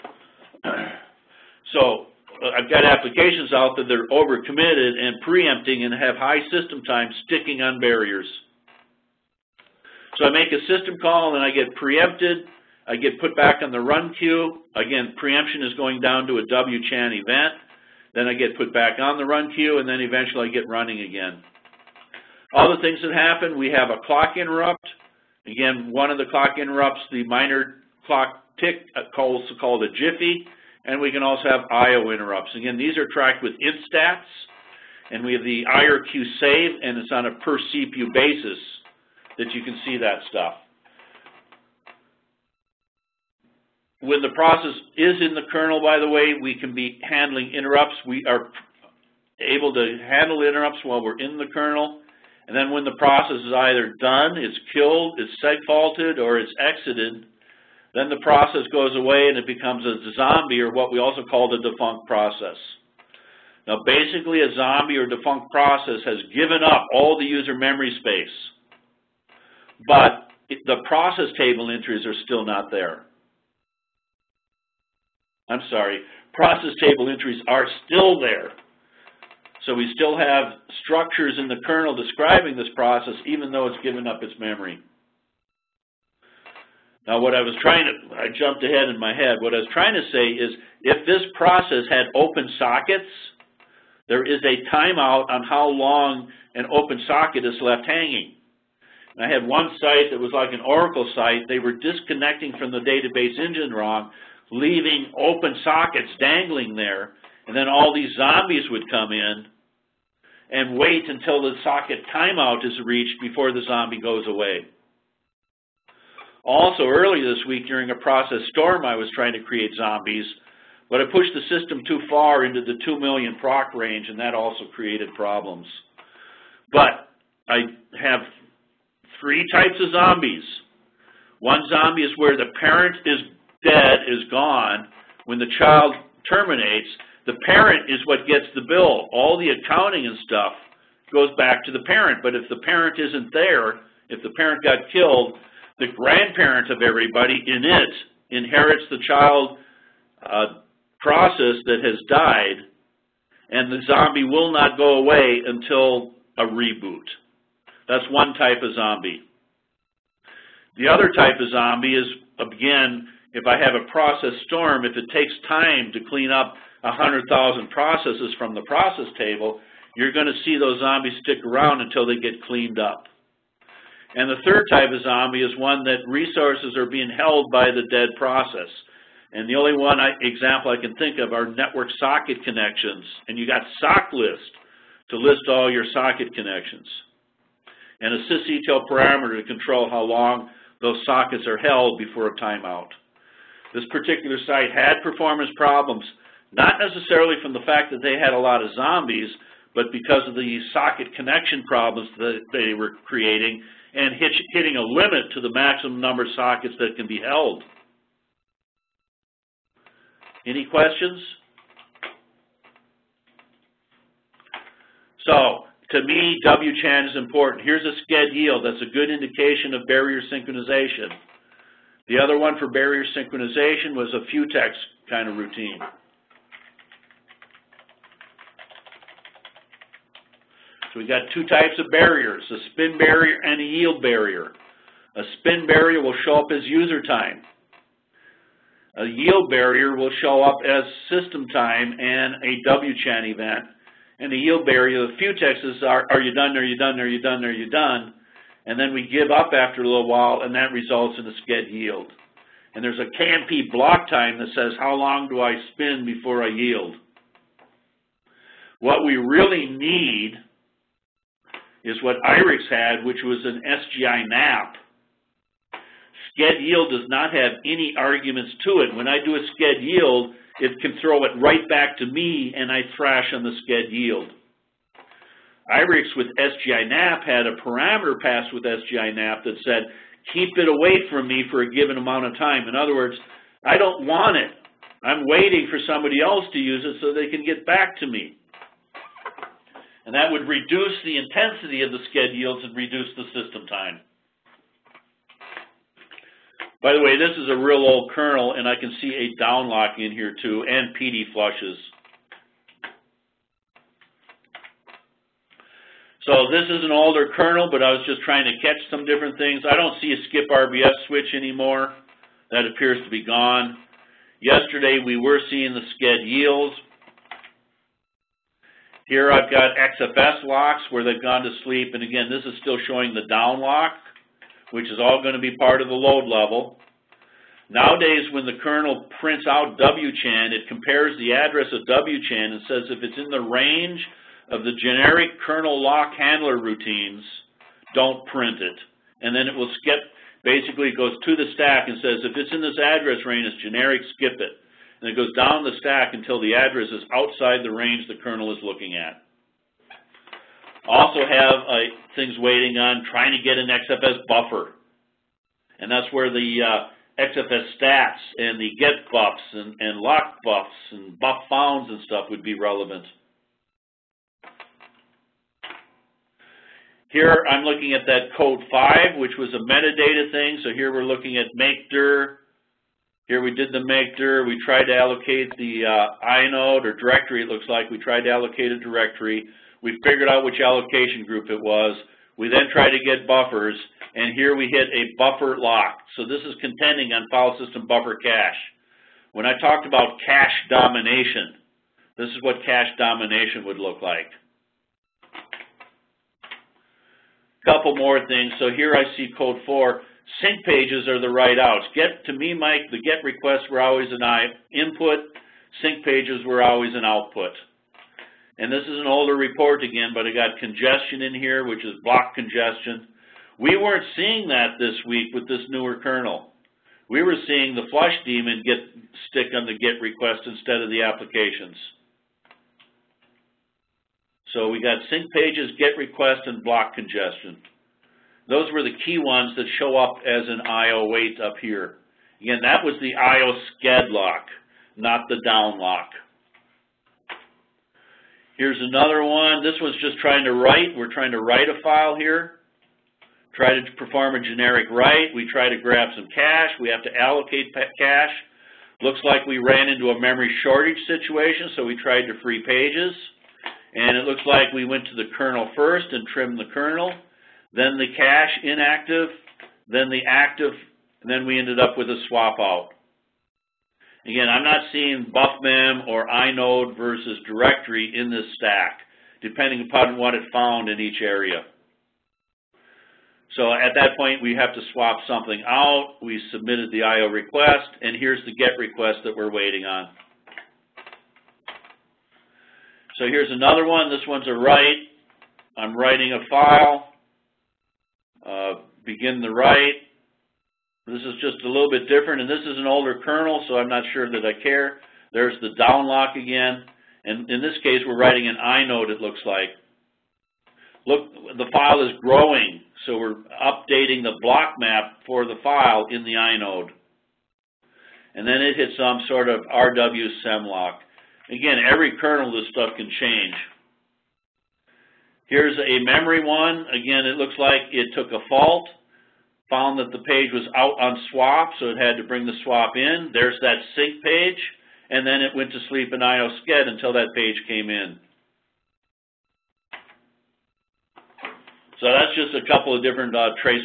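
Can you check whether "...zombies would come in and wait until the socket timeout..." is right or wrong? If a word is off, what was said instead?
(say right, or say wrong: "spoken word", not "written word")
right.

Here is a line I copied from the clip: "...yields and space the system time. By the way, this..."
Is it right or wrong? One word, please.
wrong.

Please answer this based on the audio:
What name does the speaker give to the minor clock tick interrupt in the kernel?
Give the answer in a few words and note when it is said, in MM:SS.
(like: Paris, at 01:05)
jiffy, at 00:29.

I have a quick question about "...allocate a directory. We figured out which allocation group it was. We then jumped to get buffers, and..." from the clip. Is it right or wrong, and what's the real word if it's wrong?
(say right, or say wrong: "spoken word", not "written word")
wrong: "tried", not "jumped".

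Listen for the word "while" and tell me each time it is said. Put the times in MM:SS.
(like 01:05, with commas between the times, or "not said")
00:50, 04:10.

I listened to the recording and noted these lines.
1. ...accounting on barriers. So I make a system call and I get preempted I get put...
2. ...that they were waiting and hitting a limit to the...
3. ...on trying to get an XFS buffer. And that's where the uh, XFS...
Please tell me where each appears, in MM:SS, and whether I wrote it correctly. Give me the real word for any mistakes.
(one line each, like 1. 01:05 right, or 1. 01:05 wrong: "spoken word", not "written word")
1. 00:07 wrong: "sticking", not "accounting"
2. 03:22 wrong: "creating", not "waiting"
3. 05:52 right.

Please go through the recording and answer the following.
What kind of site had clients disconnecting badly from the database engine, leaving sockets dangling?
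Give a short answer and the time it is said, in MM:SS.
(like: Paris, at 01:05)
Oracle site, at 01:40.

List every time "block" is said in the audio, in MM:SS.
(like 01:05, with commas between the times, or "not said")
04:13, 06:52, 07:06, 08:24.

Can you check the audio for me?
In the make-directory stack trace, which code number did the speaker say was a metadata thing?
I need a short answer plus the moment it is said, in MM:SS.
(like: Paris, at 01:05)
5, at 06:08.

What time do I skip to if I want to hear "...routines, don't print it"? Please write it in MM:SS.
05:36.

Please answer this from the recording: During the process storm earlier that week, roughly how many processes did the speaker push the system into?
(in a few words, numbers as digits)
2 million.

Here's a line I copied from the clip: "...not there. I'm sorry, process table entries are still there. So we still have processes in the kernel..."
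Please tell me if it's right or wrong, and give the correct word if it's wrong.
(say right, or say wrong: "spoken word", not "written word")
wrong: "structures", not "processes".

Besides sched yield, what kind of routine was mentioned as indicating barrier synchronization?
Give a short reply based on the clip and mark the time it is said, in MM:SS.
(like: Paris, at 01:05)
Futex, at 03:44.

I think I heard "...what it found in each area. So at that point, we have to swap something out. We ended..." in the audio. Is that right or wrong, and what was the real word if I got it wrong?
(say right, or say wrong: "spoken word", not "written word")
wrong: "submitted", not "ended".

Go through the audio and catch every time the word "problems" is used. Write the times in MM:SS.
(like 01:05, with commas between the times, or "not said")
02:05, 03:15, 03:21.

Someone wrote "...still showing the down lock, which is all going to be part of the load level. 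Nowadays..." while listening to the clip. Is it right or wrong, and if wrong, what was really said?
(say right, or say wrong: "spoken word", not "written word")
right.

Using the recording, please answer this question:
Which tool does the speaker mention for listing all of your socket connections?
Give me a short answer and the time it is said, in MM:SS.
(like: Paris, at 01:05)
sock list, at 03:03.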